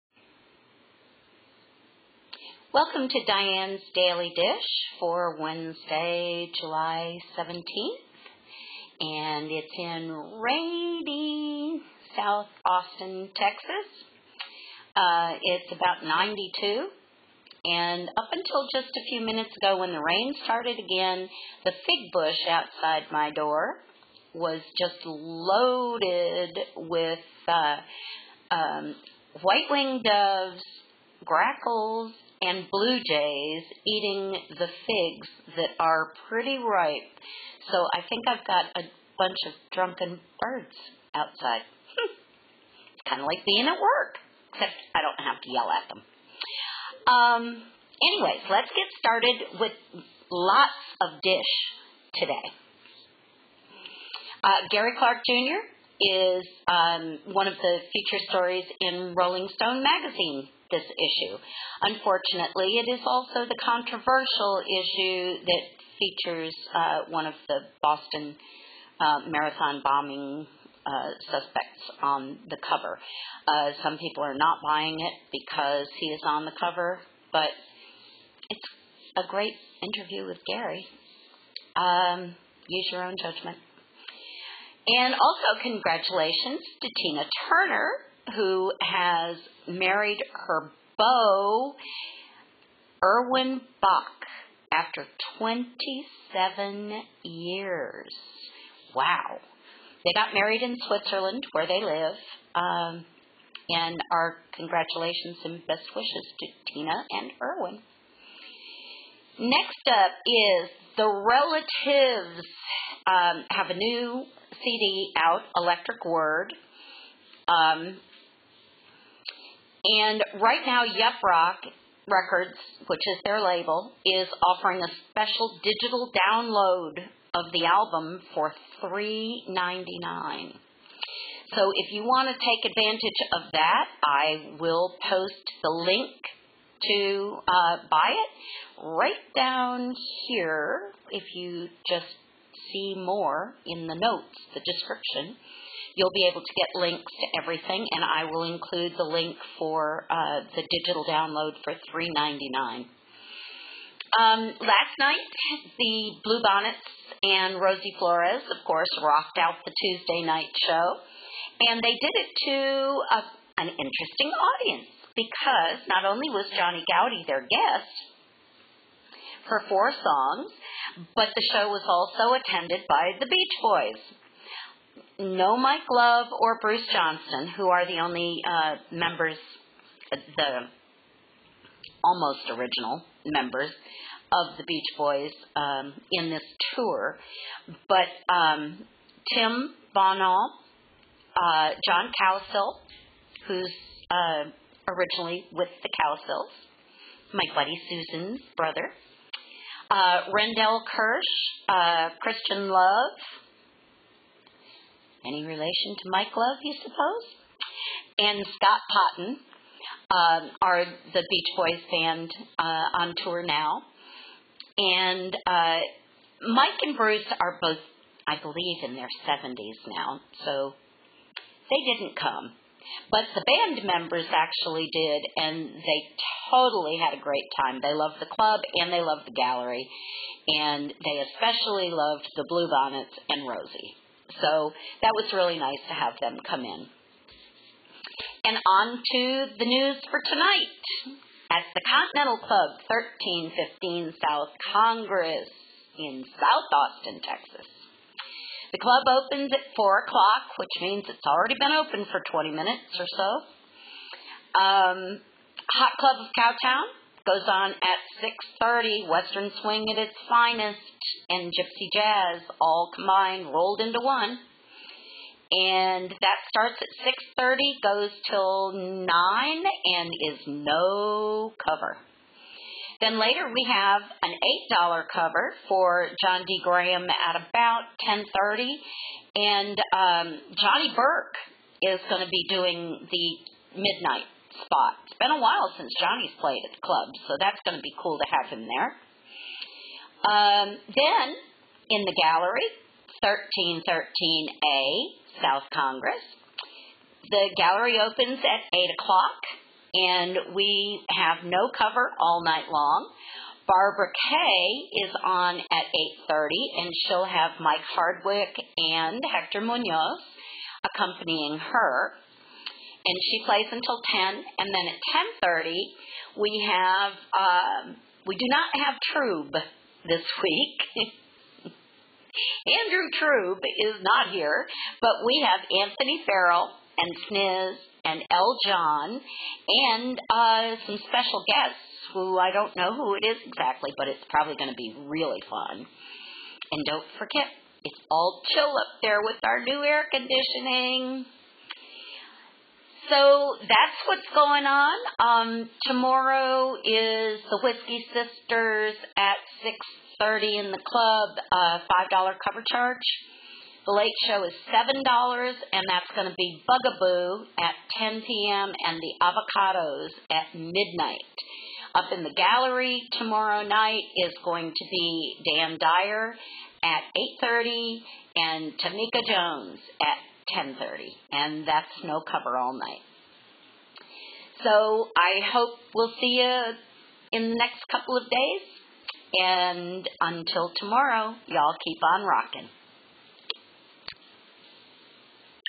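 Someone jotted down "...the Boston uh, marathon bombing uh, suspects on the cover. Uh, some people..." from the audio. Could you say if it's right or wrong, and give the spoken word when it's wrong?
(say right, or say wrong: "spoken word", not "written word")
right.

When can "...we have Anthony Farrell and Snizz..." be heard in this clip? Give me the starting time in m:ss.
5:25.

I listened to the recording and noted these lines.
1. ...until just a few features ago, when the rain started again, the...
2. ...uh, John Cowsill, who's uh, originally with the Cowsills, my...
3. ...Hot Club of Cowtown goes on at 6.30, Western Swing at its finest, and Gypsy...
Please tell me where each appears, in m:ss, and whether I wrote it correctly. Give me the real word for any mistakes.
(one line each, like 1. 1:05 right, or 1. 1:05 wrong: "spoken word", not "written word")
1. 0:18 wrong: "minutes", not "features"
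2. 3:11 right
3. 4:15 right.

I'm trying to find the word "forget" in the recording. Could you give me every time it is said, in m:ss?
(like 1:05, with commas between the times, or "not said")
5:37.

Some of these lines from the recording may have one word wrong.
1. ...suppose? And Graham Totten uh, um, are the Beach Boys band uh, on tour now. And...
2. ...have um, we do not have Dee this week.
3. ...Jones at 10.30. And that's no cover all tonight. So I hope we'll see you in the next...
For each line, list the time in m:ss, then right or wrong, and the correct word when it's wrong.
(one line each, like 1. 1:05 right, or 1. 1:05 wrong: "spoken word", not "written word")
1. 3:26 wrong: "Scott", not "Graham"
2. 5:16 wrong: "Trube", not "Dee"
3. 6:09 wrong: "night", not "tonight".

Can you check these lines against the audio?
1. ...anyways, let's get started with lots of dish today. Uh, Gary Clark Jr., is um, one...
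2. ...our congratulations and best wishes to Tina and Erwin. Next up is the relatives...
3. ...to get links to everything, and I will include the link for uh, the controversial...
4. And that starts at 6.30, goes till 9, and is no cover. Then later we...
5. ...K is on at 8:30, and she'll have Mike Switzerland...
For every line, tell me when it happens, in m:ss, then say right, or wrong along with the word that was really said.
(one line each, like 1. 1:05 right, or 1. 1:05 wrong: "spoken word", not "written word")
1. 0:48 right
2. 1:44 right
3. 2:26 wrong: "digital", not "controversial"
4. 4:25 right
5. 5:04 wrong: "Hardwick", not "Switzerland".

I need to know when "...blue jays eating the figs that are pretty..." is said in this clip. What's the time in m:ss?
0:32.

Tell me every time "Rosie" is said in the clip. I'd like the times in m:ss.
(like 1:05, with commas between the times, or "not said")
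2:37, 3:53.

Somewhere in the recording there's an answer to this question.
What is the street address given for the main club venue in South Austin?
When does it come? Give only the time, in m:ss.
4:02.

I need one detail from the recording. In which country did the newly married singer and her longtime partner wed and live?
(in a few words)
Switzerland.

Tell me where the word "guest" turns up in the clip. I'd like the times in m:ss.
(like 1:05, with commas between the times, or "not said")
2:47, 5:31.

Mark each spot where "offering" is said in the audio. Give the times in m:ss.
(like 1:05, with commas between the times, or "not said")
2:04.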